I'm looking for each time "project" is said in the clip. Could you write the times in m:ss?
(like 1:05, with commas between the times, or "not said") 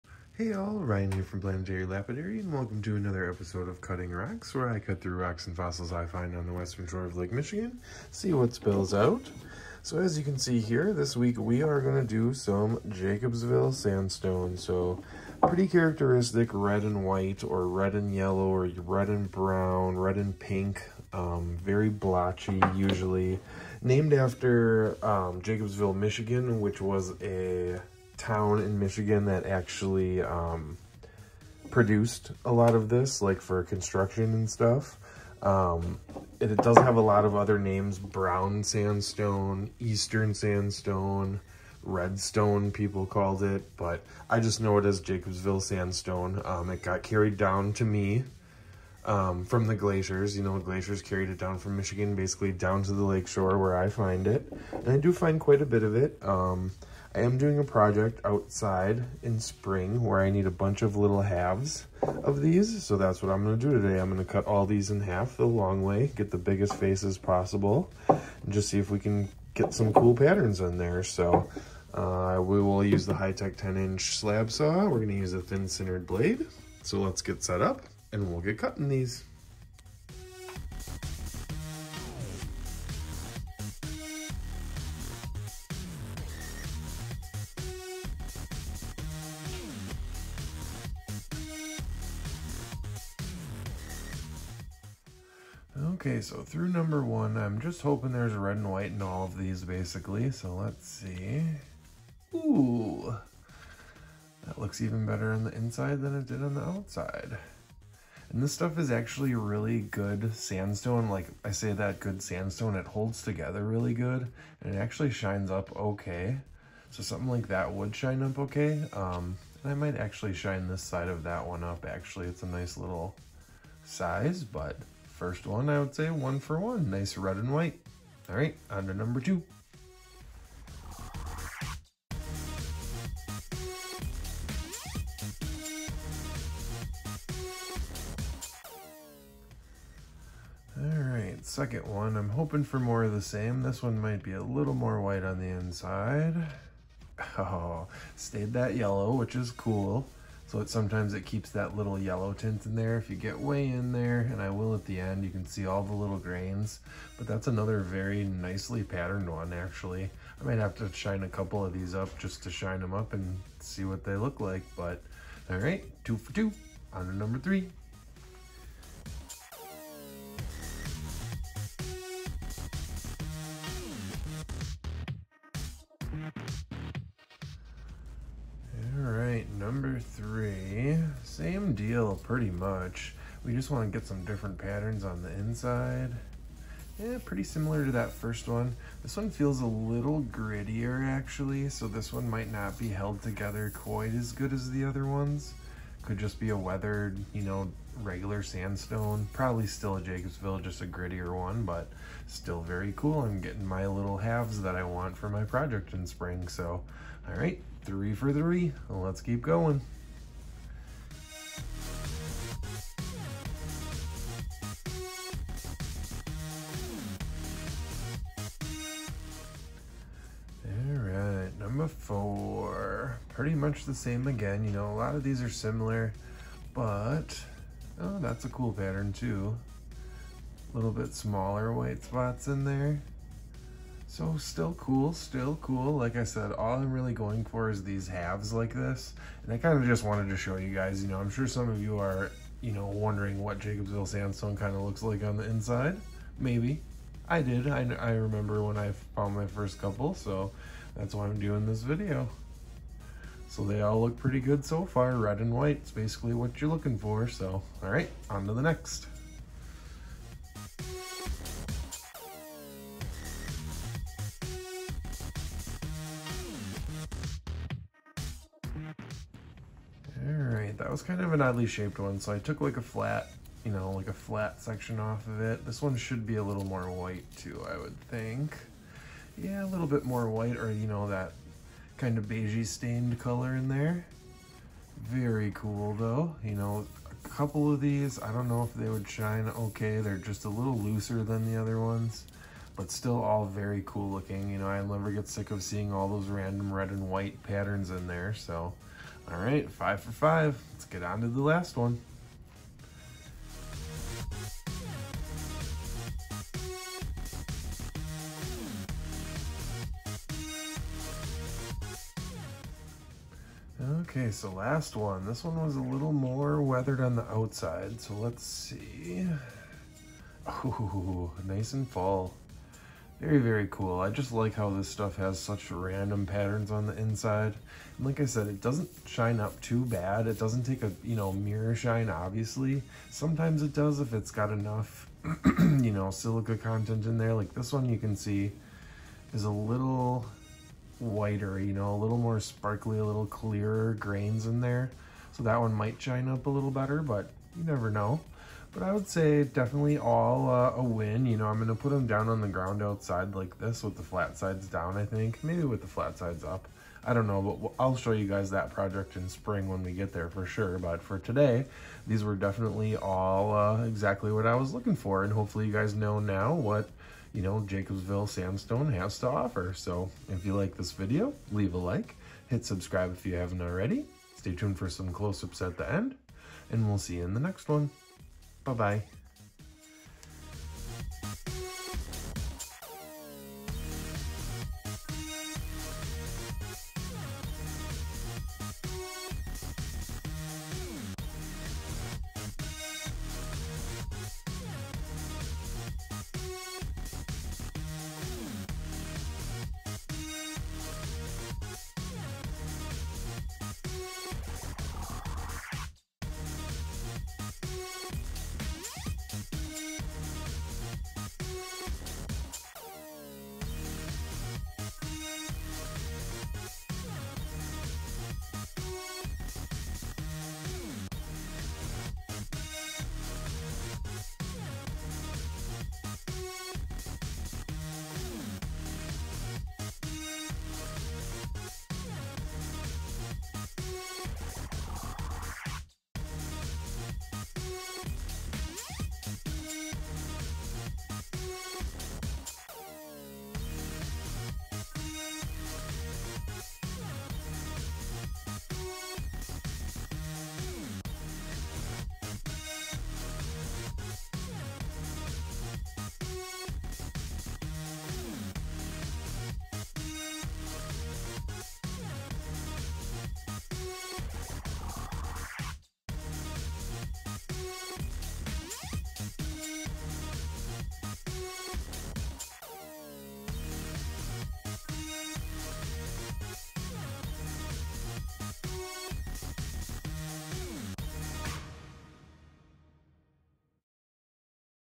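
0:57, 3:25, 5:58.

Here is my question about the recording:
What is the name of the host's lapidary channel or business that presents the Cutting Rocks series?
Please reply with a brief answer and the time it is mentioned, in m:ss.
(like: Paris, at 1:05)
Planetary Jerry Lapidary, at 0:01.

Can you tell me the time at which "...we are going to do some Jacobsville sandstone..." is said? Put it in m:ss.
0:11.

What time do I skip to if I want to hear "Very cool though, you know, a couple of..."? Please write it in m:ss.
4:45.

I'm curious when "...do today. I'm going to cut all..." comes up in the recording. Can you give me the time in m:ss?
1:03.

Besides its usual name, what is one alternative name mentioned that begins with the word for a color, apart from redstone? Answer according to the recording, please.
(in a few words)
brown sandstone.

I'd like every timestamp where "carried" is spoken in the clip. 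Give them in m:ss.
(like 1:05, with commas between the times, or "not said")
0:47, 0:51.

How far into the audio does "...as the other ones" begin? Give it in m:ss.
3:14.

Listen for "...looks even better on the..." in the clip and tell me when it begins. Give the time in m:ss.
1:44.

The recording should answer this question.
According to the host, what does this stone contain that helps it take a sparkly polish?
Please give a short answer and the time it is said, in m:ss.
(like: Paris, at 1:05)
silica, at 5:36.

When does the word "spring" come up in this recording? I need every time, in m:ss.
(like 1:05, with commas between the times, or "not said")
0:59, 3:26, 5:59.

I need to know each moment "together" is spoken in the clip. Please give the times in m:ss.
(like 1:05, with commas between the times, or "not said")
1:53, 3:13.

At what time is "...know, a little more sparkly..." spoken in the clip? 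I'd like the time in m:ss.
5:41.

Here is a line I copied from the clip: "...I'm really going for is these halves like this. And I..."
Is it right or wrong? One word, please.
right.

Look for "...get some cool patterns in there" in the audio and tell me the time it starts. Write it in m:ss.
1:09.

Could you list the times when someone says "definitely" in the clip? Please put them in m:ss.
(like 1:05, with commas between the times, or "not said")
5:49, 6:02.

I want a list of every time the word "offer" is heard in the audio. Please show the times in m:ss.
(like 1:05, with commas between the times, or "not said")
6:09.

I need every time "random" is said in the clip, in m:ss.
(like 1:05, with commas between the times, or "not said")
4:56, 5:25.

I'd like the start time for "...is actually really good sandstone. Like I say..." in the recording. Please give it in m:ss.
1:48.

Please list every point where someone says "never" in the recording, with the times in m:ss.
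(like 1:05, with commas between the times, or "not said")
4:54, 5:47.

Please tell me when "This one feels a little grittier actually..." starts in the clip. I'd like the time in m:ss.
3:09.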